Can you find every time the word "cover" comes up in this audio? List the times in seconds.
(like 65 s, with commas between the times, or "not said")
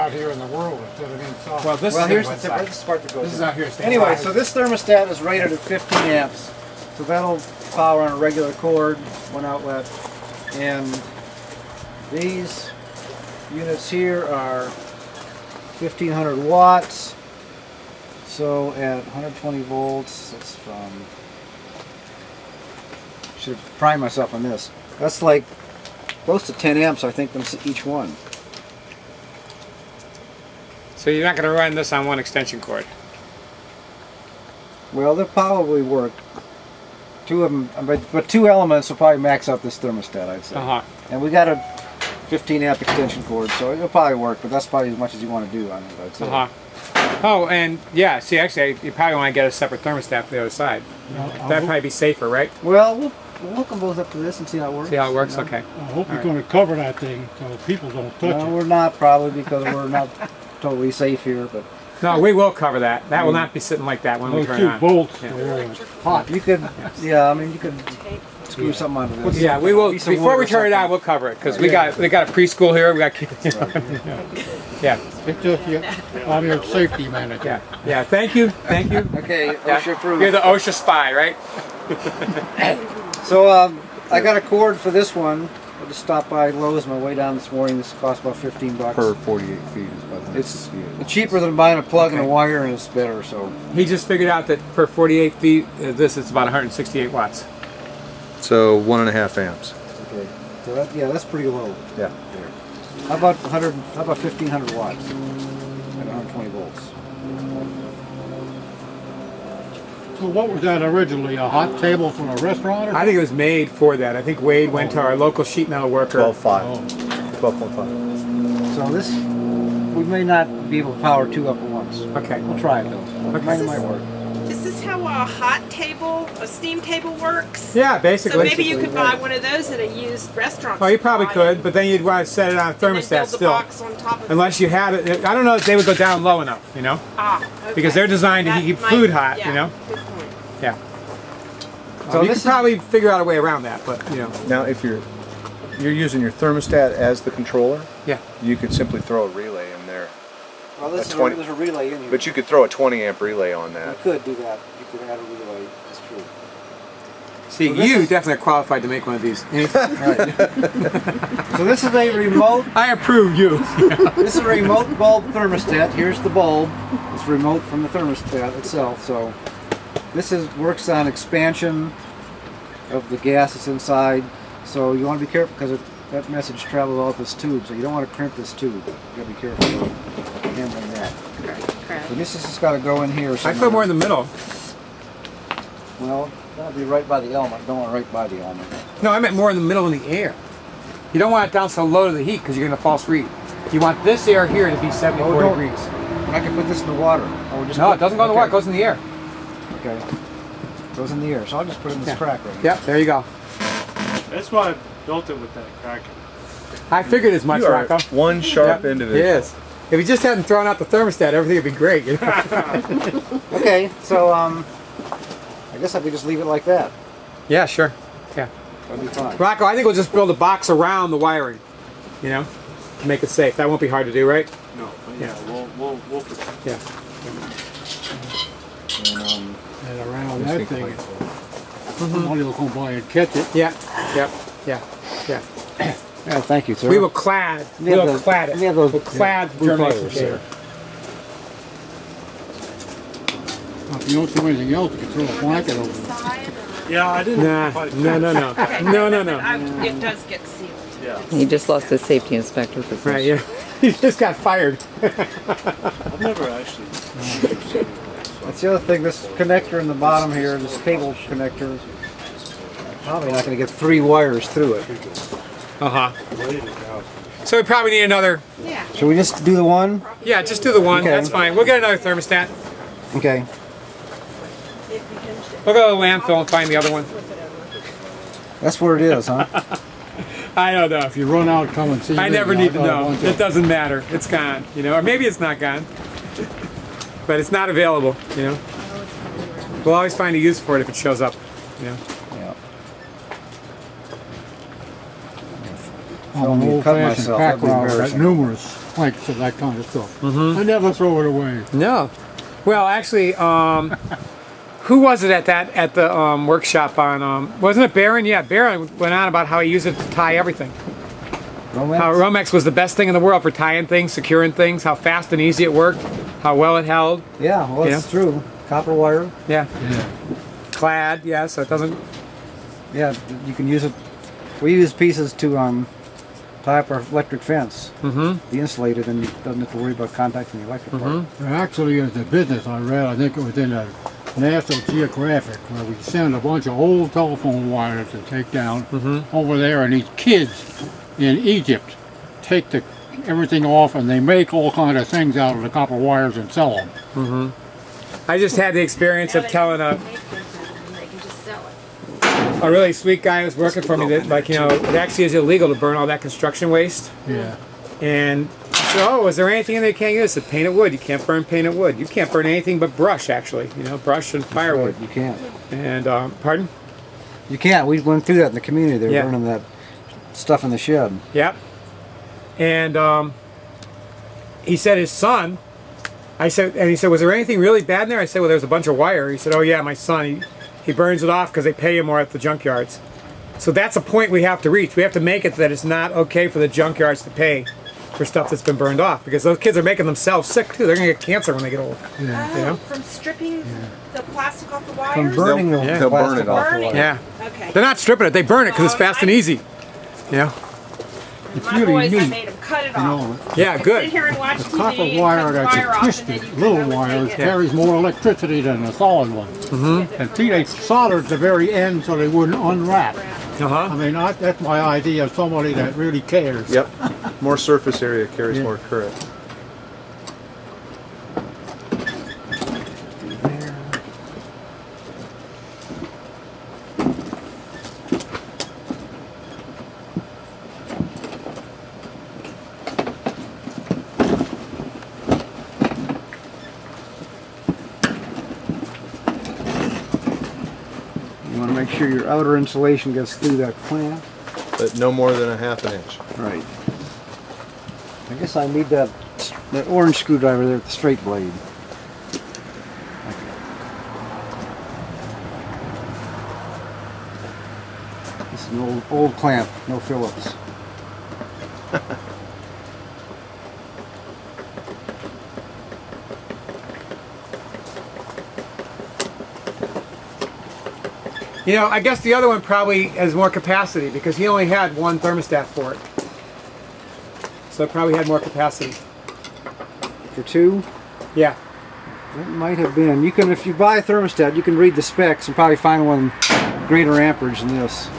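56 s, 62 s, 70 s.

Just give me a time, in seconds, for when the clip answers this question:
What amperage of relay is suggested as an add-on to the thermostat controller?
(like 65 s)
152 s.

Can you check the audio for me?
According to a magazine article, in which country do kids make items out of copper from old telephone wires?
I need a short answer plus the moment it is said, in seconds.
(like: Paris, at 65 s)
Egypt, at 341 s.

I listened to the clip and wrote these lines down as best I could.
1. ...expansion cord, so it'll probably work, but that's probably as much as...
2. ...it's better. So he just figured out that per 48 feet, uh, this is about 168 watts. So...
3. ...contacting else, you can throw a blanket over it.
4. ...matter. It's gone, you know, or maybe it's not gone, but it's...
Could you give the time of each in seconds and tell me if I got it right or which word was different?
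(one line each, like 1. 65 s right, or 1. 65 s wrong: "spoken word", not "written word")
1. 42 s wrong: "extension", not "expansion"
2. 92 s right
3. 244 s wrong: "anything", not "contacting"
4. 283 s right.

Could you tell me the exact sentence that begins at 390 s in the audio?
They're going to get cancer when they get old.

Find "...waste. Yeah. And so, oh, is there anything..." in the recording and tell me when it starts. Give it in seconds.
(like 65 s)
356 s.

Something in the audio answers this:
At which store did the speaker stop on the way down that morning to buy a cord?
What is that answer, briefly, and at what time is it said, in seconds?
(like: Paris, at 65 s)
Lowe's, at 86 s.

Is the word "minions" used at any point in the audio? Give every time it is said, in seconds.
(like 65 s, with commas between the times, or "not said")
not said.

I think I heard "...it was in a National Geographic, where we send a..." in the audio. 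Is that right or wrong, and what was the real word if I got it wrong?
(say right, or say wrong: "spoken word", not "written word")
right.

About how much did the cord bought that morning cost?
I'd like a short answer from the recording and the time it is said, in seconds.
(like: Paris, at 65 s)
15 bucks, at 88 s.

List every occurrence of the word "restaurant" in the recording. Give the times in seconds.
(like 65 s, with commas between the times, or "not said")
112 s, 130 s.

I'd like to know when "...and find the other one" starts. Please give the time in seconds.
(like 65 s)
276 s.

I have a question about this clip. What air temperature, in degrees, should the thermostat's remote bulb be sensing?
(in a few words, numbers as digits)
74 degrees.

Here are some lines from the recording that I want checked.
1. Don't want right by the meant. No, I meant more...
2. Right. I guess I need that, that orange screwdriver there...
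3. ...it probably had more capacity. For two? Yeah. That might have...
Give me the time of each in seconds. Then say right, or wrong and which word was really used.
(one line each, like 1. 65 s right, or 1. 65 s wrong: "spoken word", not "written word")
1. 187 s wrong: "element", not "meant"
2. 446 s right
3. 477 s right.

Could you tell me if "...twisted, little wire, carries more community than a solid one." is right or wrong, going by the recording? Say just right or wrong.
wrong.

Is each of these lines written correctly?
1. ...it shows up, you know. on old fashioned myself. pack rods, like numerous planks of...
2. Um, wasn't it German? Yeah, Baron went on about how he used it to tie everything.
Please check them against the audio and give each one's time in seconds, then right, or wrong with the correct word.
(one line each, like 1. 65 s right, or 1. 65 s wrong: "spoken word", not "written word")
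1. 290 s right
2. 307 s wrong: "Baron", not "German".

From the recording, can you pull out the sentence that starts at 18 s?
So at 120 volts, that's from, should prime myself on this.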